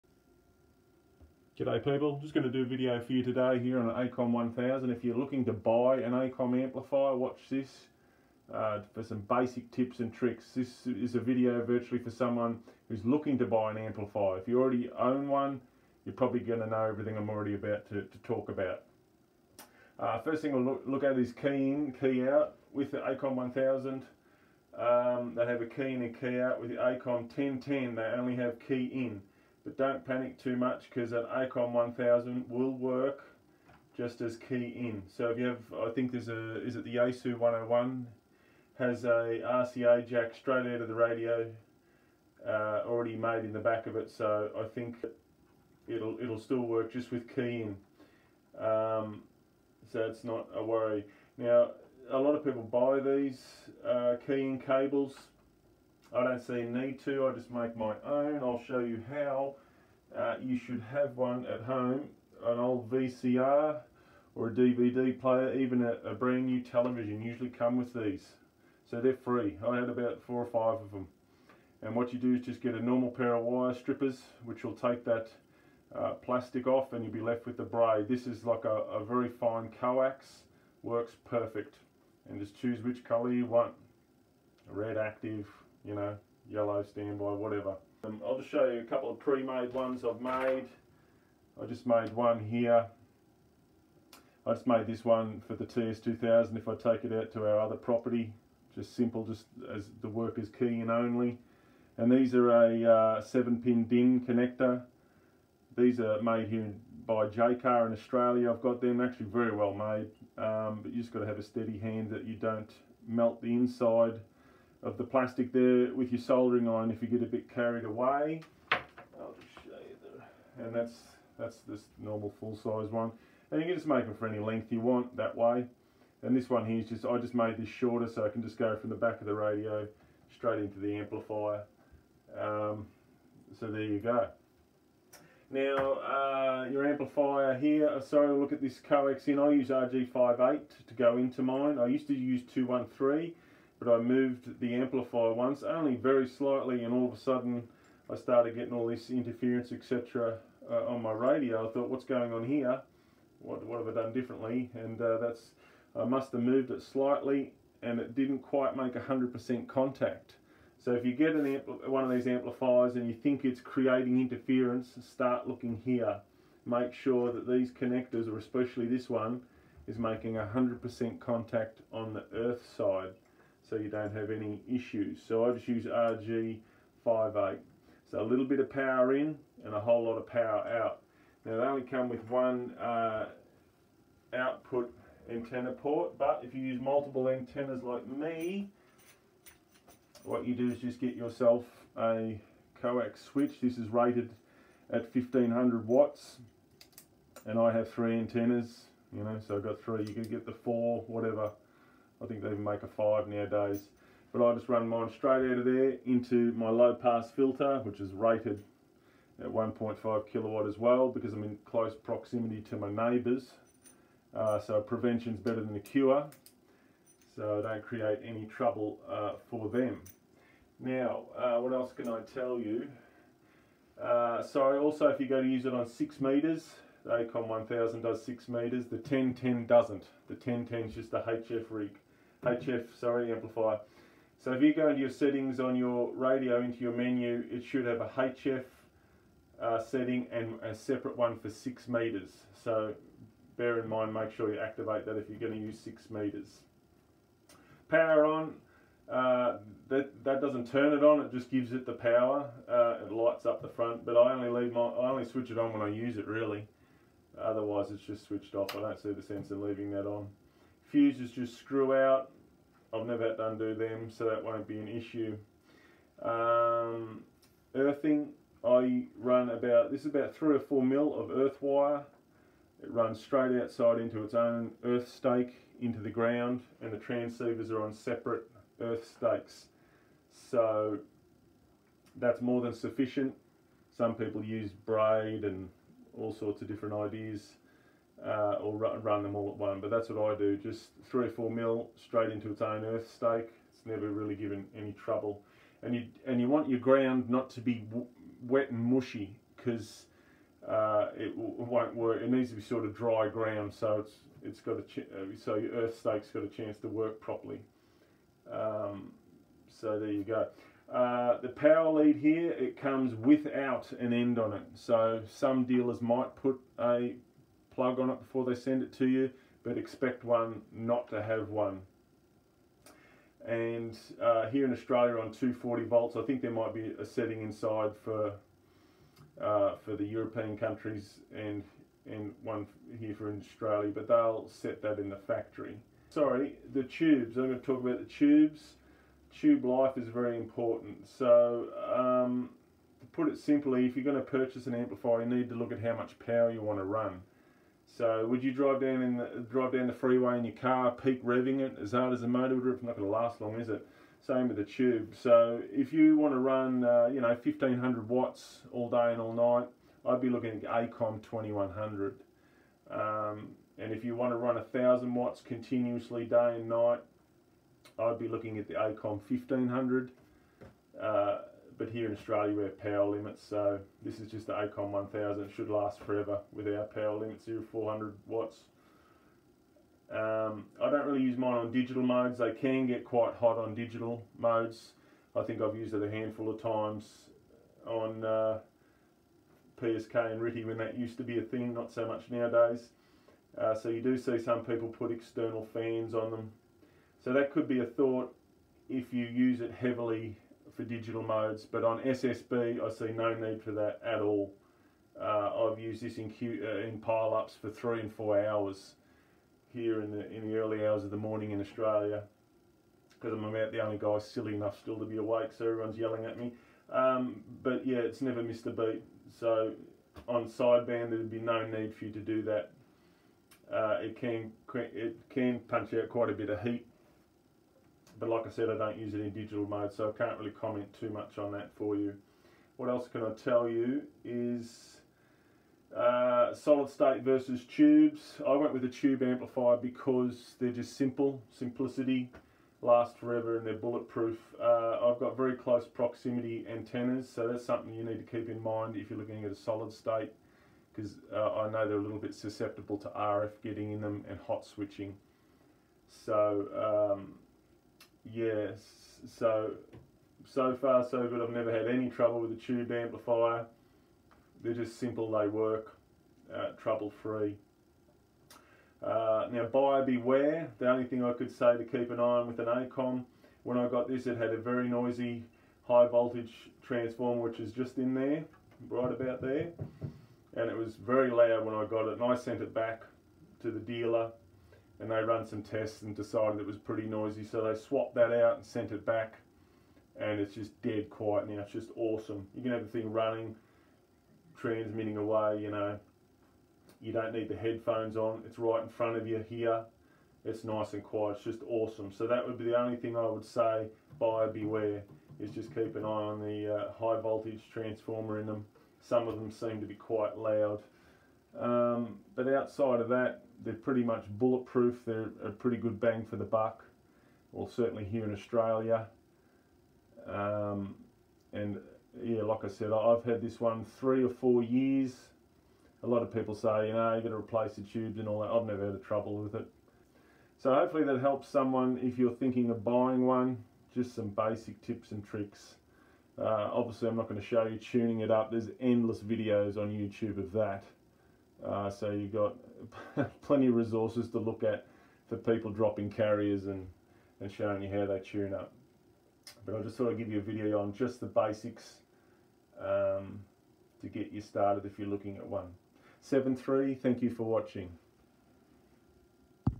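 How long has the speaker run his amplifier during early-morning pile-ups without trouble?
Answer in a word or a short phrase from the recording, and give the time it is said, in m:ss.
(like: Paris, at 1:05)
3 and 4 hours, at 6:47.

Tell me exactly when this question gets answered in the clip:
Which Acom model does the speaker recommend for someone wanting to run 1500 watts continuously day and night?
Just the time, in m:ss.
6:00.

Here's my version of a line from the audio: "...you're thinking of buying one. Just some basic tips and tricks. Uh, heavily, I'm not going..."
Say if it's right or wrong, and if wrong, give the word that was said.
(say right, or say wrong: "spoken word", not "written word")
wrong: "obviously", not "heavily".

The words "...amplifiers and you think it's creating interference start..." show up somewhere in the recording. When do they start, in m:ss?
2:42.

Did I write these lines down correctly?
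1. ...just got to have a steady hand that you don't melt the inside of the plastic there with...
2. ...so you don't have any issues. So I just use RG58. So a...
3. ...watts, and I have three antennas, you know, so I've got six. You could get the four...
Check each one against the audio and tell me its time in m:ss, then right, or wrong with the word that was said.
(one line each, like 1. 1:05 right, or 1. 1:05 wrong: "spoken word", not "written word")
1. 1:51 right
2. 2:53 right
3. 3:15 wrong: "three", not "six".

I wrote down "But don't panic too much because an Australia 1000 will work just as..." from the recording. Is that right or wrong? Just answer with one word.
wrong.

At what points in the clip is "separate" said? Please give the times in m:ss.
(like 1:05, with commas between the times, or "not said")
4:00, 4:37.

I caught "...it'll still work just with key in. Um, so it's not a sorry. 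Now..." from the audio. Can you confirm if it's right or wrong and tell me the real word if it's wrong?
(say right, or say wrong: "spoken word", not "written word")
wrong: "worry", not "sorry".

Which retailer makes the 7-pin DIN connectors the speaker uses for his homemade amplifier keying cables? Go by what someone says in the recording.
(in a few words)
Jaycar.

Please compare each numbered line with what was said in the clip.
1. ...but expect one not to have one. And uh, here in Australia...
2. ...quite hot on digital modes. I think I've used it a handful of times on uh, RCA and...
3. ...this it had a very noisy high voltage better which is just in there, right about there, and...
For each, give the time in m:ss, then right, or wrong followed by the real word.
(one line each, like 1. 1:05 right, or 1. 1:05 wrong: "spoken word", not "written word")
1. 5:19 right
2. 6:23 wrong: "PSK", not "RCA"
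3. 7:54 wrong: "transformer", not "better".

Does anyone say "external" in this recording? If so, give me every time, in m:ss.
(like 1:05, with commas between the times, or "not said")
6:35.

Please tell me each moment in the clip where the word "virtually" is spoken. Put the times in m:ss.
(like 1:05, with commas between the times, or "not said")
0:11.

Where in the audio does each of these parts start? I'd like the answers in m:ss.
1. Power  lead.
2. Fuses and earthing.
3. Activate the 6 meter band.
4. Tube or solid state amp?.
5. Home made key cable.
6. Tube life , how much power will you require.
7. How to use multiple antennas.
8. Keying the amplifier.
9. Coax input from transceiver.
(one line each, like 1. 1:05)
1. 5:10
2. 4:20
3. 3:54
4. 7:16
5. 1:00
6. 5:36
7. 2:58
8. 0:20
9. 2:19.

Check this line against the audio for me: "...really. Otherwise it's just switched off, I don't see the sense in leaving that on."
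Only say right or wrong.
right.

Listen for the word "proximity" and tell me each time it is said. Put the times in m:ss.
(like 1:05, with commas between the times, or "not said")
3:31, 7:25.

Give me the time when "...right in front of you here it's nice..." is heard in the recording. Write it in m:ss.
8:18.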